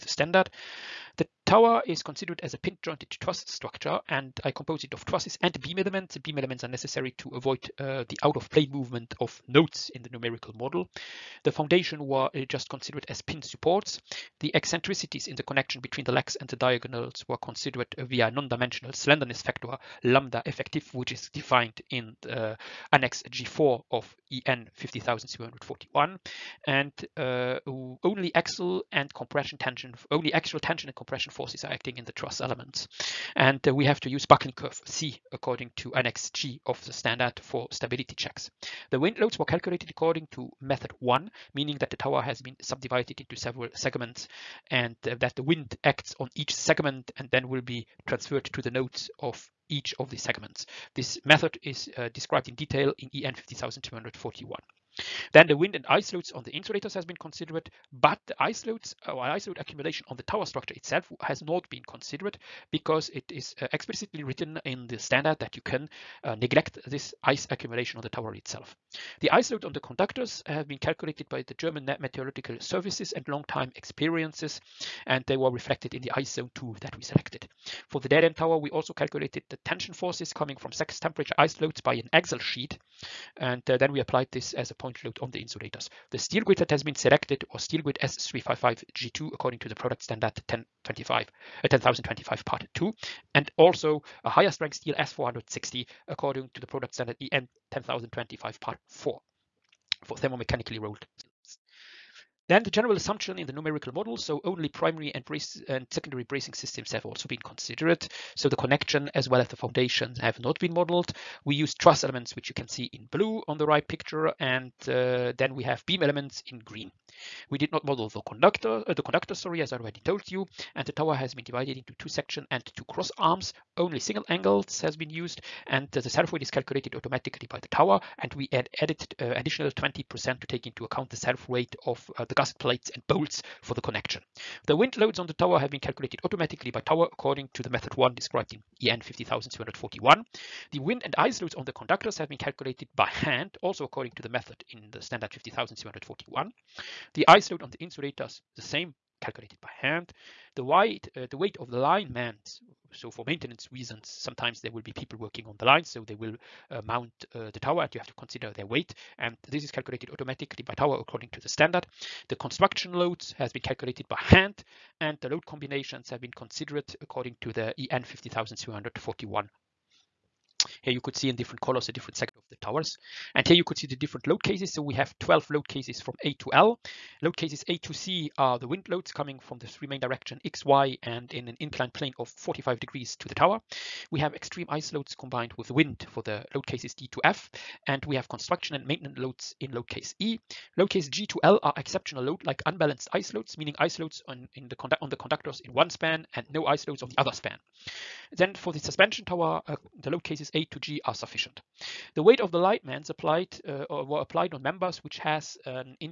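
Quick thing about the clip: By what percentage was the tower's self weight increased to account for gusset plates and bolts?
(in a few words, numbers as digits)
20%.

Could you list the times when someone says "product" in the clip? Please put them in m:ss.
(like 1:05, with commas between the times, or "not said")
1:29, 1:36.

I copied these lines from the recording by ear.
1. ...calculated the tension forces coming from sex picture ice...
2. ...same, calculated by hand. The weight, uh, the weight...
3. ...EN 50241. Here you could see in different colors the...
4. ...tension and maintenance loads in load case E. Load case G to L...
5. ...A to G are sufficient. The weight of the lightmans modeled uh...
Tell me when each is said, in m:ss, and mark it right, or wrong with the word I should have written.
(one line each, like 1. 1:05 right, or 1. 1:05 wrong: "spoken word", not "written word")
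1. 1:18 wrong: "temperature", not "picture"
2. 2:28 right
3. 2:47 right
4. 3:08 wrong: "construction", not "tension"
5. 3:20 wrong: "applied", not "modeled".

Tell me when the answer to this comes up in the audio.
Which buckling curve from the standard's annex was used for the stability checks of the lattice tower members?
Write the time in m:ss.
0:34.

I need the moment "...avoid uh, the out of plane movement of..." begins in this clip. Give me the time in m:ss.
0:07.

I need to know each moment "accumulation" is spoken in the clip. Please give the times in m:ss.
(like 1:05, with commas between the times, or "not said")
0:59, 1:07.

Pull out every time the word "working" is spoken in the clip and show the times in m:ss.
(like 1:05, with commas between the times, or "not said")
2:35.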